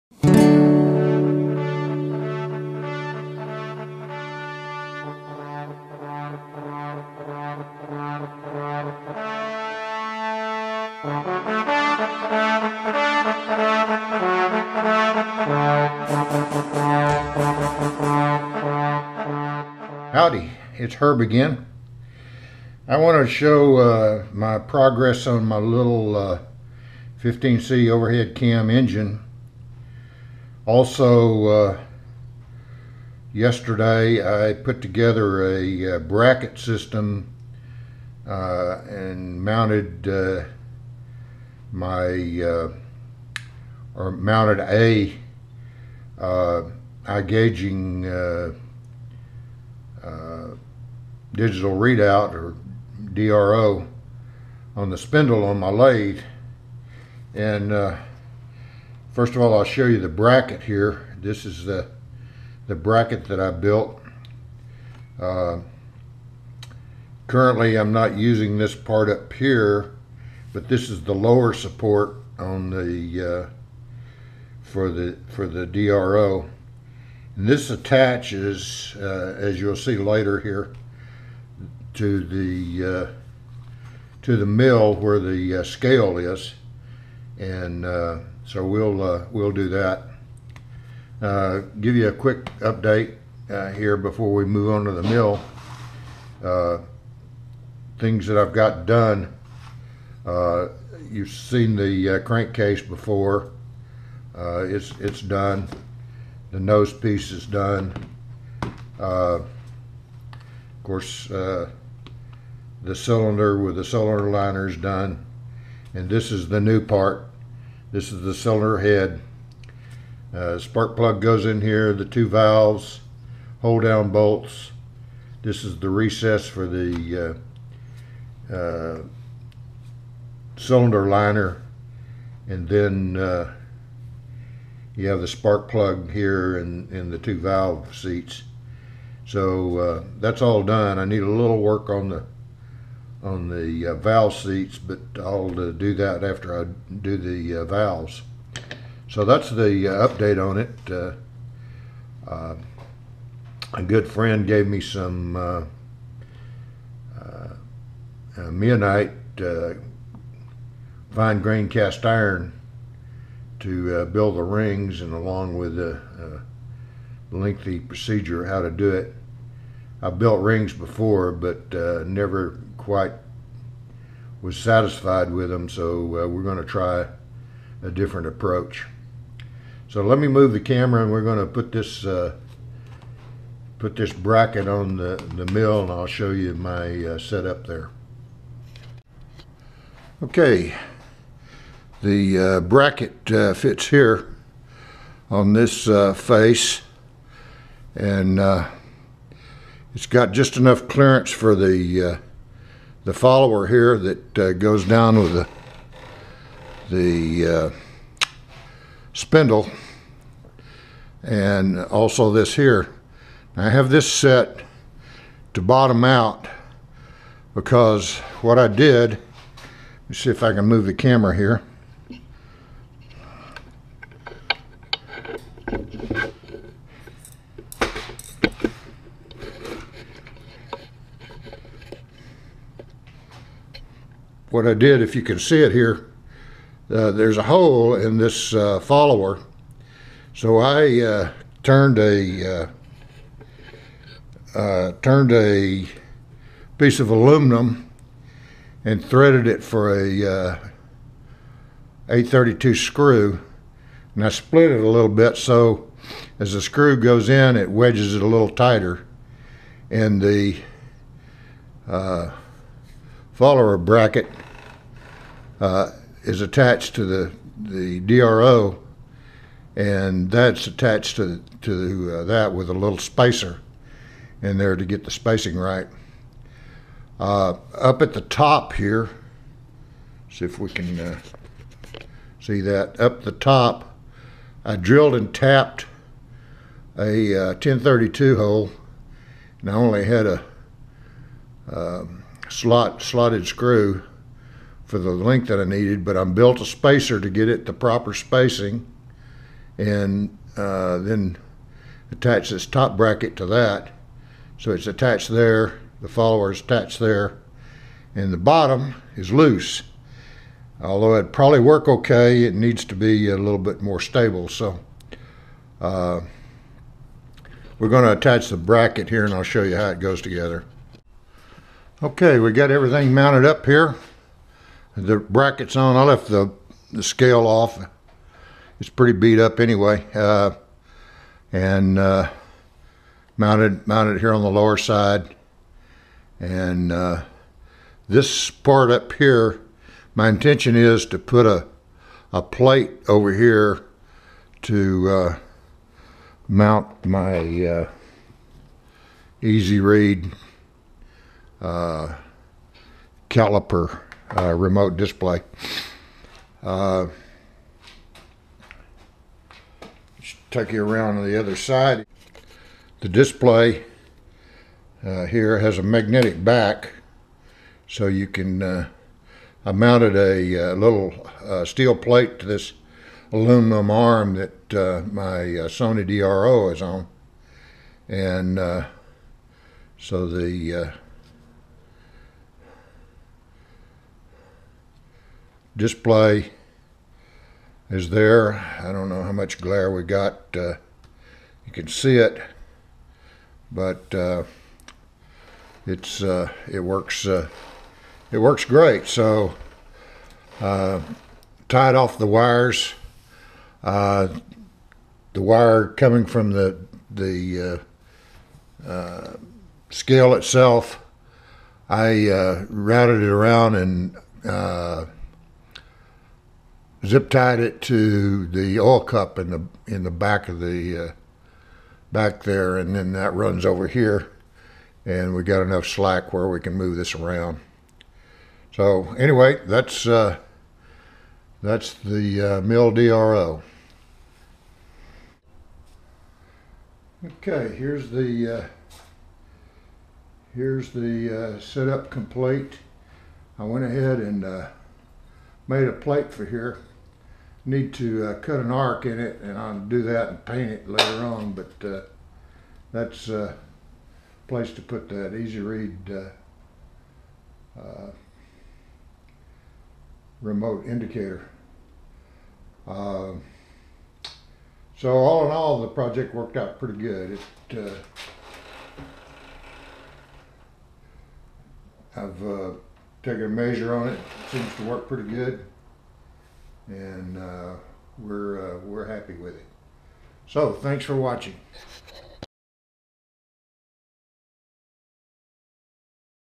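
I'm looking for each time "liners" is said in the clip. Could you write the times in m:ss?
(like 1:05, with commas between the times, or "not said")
1:54, 2:11.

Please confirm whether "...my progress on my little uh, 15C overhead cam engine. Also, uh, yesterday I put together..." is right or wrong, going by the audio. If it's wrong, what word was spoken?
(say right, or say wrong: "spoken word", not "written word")
right.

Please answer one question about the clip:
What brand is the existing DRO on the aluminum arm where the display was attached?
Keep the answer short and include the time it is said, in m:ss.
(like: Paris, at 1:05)
Sony, at 6:15.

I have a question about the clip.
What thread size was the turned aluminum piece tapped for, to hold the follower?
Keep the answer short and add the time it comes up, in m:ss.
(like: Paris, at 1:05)
8-32, at 4:12.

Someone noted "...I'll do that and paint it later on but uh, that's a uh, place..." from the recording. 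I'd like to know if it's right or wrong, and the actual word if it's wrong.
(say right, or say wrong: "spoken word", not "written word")
right.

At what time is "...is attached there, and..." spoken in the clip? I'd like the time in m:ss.
5:06.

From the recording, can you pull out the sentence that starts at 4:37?
Uh, up at the top here, see if we can uh, see that.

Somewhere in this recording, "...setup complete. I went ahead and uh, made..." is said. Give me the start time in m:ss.
7:21.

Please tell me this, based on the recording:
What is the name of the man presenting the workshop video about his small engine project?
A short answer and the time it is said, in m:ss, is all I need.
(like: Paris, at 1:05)
Herb, at 0:20.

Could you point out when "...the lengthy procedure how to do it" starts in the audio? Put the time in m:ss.
2:45.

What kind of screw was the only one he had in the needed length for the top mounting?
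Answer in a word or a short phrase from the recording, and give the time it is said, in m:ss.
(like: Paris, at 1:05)
slotted screw, at 4:53.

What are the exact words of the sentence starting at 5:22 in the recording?
Okay, we got everything mounted up here.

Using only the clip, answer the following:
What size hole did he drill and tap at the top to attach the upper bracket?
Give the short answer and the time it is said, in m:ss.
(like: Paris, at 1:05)
10-32, at 4:47.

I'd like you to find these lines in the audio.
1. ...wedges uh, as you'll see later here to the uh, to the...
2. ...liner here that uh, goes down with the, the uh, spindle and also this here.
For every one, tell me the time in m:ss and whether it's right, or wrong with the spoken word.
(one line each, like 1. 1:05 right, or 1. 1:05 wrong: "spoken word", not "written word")
1. 1:17 wrong: "attaches", not "wedges"
2. 3:23 wrong: "follower", not "liner".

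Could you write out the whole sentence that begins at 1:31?
Uh, give you a quick update here before we move on to the mill.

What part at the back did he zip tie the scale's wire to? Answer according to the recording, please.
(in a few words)
the oil cup.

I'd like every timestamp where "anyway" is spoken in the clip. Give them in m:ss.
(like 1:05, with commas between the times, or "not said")
5:29, 7:09.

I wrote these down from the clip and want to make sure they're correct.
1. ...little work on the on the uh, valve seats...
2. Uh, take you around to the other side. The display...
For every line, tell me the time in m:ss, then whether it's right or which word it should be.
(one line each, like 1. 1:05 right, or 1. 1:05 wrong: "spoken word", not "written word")
1. 2:21 right
2. 5:56 right.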